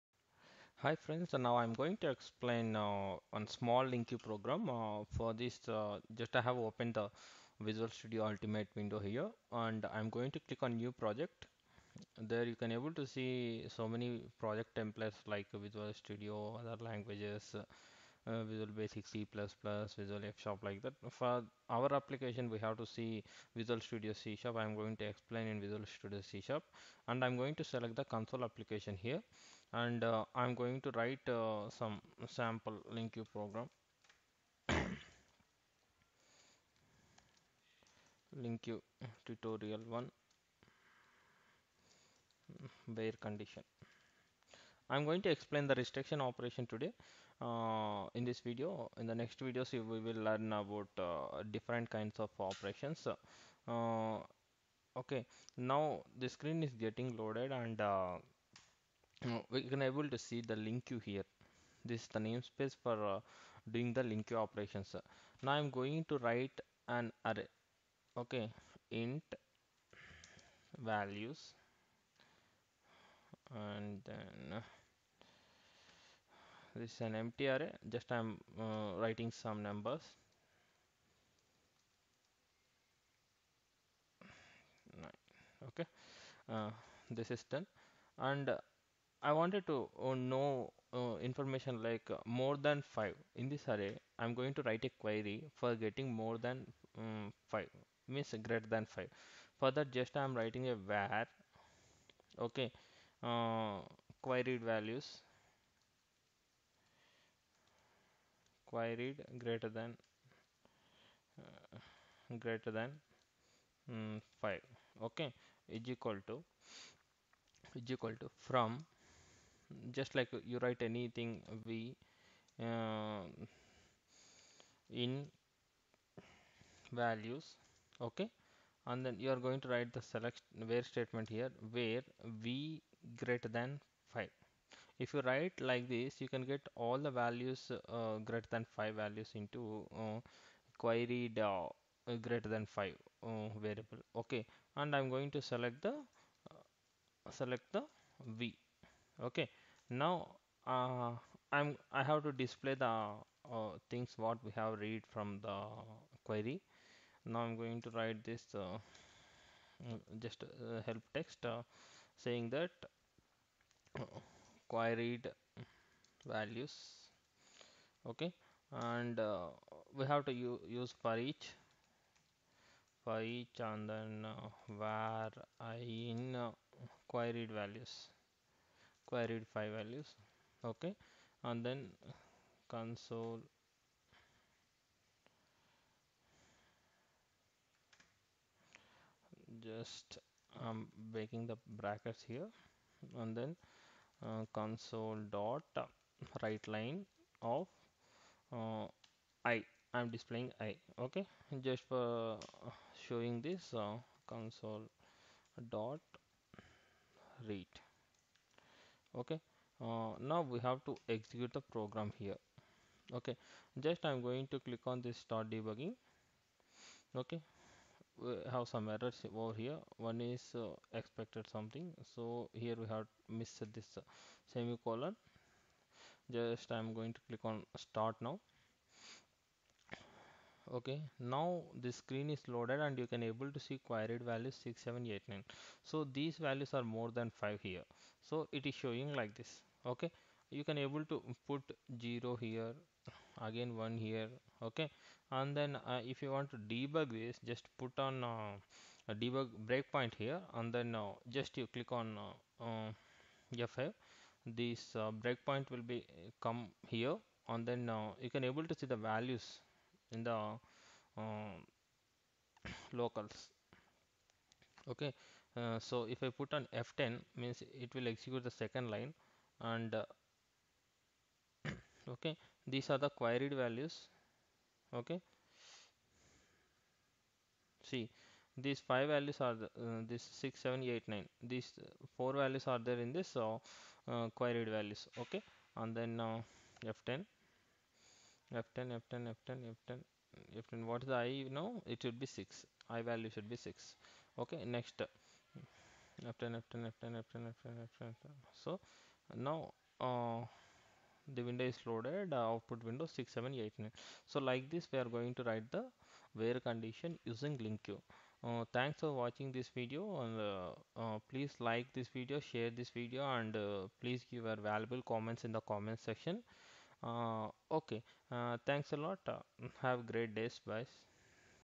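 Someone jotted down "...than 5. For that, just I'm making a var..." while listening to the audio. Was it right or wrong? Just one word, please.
wrong.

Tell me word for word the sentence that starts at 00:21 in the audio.
For our application we have to see Visual Studio C Sharp.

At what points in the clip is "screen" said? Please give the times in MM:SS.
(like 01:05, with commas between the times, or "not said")
00:56, 03:51.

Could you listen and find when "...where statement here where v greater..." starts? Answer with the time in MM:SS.
02:10.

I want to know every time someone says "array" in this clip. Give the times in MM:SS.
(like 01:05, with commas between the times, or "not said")
01:07, 01:17, 01:33.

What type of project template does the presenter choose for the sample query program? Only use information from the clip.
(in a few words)
Console application.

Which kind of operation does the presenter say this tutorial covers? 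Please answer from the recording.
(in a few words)
Restriction operation.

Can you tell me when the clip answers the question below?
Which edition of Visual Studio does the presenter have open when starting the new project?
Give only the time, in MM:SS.
00:08.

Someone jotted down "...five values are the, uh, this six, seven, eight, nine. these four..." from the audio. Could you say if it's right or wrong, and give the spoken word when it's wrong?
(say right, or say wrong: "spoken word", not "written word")
right.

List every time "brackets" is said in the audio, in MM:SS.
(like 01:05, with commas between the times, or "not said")
03:11.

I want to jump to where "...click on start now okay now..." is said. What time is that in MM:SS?
03:47.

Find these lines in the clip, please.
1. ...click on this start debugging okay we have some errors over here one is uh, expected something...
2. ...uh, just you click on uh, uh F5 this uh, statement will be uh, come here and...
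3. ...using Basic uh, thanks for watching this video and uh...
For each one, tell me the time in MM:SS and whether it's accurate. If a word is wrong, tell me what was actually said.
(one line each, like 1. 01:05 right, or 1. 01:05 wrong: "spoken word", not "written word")
1. 03:34 right
2. 04:10 wrong: "breakpoint", not "statement"
3. 05:07 wrong: "LINQ", not "Basic".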